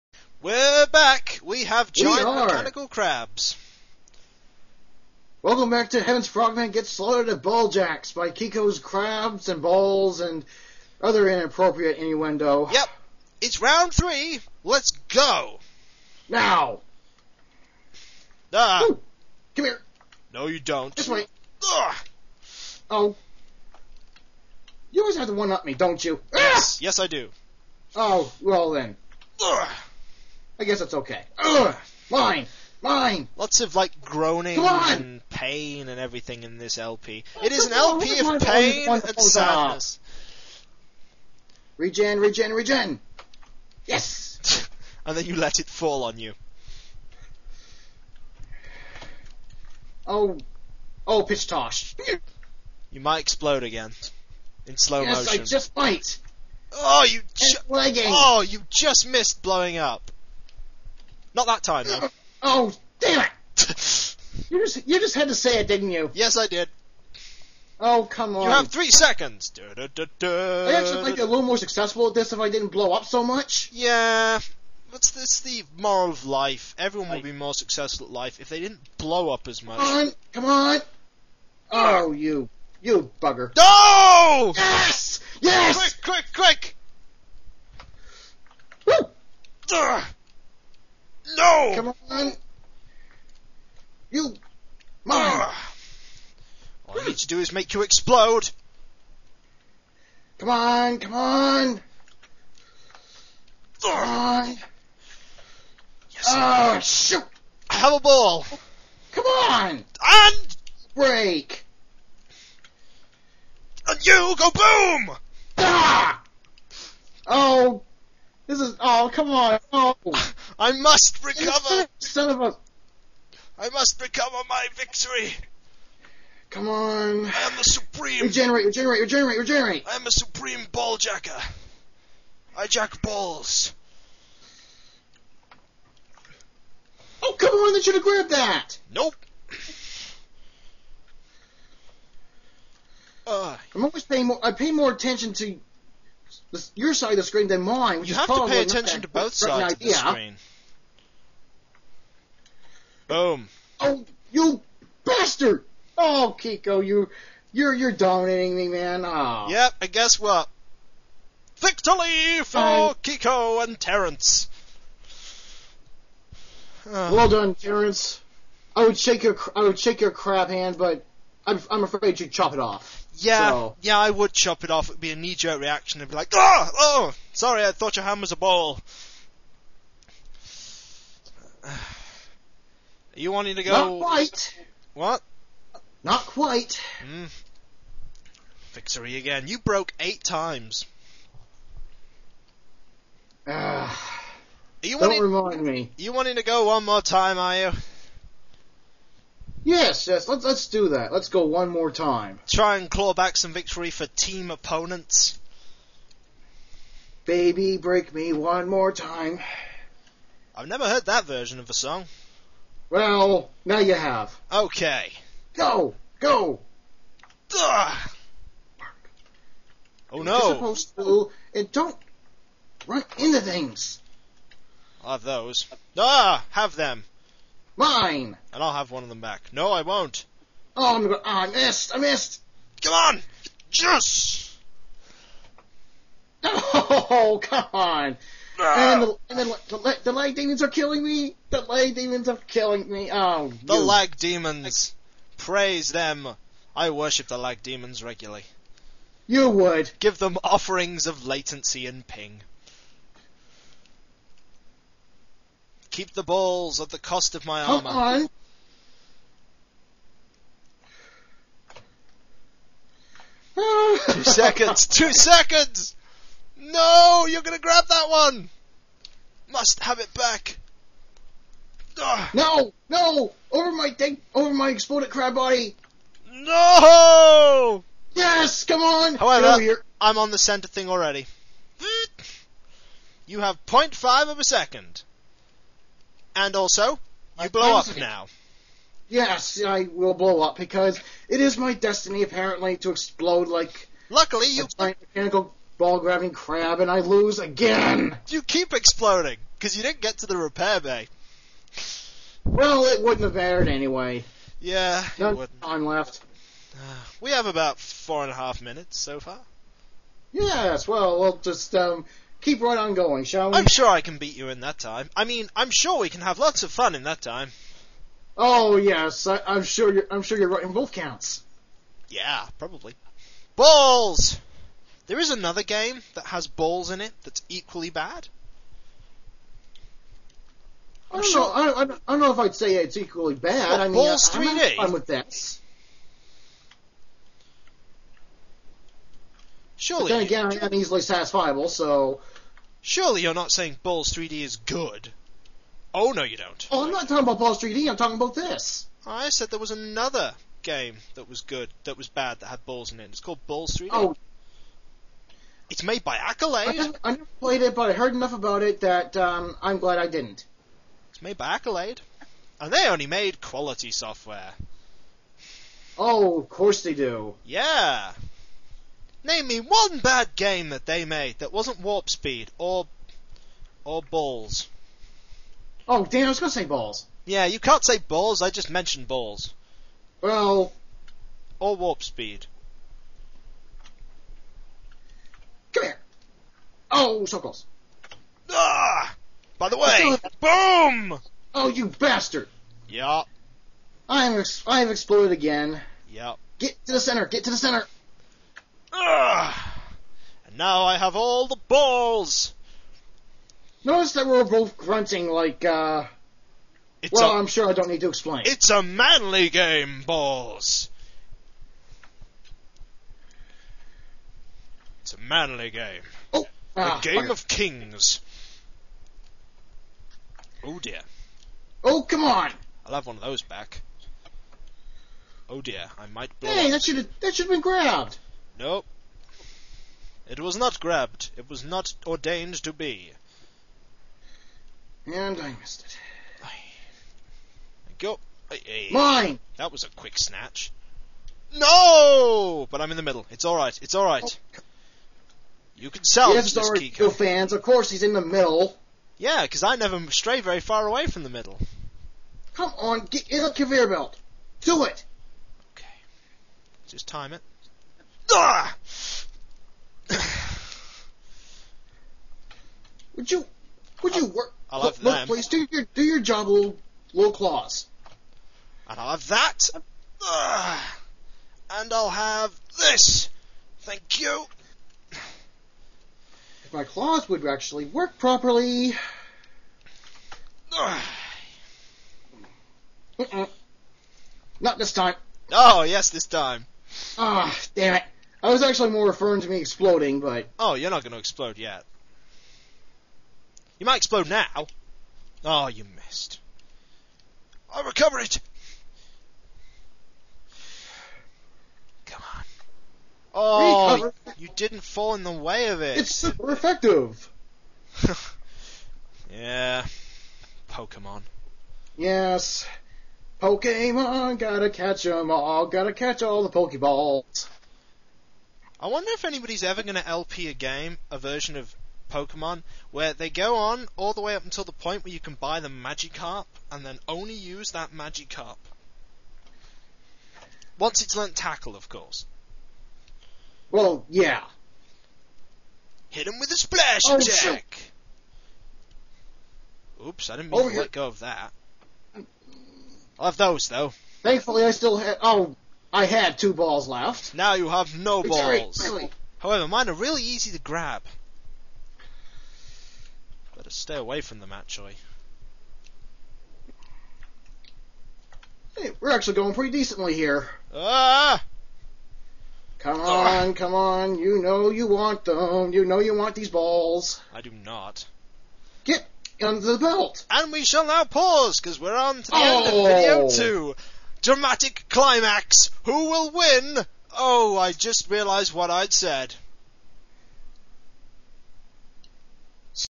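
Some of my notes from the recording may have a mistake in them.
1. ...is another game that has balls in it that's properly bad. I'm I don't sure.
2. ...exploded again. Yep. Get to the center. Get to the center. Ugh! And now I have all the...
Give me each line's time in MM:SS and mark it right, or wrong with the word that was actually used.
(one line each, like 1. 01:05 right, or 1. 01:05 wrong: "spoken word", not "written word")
1. 05:25 wrong: "equally", not "properly"
2. 06:34 right.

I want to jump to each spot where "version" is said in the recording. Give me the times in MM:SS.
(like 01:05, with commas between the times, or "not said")
03:31, 08:41.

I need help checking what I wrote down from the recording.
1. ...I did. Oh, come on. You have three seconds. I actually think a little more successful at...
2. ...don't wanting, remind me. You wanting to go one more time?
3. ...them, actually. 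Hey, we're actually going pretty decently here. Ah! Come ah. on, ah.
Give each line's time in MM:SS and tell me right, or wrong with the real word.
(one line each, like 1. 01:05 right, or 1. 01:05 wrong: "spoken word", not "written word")
1. 01:06 right
2. 03:14 right
3. 09:14 right.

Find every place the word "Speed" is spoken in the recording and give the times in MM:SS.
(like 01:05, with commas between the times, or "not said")
06:12, 06:22.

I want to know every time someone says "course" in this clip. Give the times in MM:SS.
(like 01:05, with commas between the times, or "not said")
06:06, 07:27, 08:51.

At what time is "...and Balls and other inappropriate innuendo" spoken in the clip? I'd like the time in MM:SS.
00:09.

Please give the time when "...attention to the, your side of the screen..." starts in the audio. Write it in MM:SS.
02:24.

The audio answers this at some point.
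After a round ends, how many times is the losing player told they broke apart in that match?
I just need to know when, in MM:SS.
03:09.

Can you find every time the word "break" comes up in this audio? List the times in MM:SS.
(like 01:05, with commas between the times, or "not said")
01:50, 03:27.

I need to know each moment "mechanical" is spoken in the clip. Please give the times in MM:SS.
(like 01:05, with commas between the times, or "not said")
00:02, 04:55.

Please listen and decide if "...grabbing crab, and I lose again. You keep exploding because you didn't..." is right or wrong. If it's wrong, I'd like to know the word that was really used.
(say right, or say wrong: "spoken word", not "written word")
right.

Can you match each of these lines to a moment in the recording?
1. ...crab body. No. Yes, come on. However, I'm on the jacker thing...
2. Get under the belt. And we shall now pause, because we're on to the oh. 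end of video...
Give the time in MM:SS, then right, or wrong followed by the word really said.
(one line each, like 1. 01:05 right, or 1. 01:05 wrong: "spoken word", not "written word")
1. 04:35 wrong: "center", not "jacker"
2. 09:28 right.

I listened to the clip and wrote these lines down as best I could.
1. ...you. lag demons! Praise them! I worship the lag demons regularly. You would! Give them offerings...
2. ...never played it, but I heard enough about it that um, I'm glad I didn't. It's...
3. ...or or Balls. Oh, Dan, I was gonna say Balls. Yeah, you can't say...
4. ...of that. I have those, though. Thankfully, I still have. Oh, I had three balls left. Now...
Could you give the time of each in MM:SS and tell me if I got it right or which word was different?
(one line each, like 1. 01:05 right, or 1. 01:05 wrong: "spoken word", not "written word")
1. 04:03 right
2. 05:57 right
3. 06:12 right
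4. 09:01 wrong: "two", not "three".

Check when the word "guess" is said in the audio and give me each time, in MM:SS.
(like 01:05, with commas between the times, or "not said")
00:30, 02:39.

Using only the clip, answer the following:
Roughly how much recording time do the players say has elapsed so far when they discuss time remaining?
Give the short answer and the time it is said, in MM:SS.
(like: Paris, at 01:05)
4 and a half minutes, at 05:07.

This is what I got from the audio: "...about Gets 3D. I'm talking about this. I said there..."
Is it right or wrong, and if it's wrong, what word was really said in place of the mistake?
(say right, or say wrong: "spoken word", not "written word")
wrong: "Ballz", not "Gets".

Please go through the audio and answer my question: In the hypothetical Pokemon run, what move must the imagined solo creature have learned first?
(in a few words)
Tackle.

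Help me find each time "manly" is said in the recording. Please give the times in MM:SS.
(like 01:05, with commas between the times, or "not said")
06:48, 06:55.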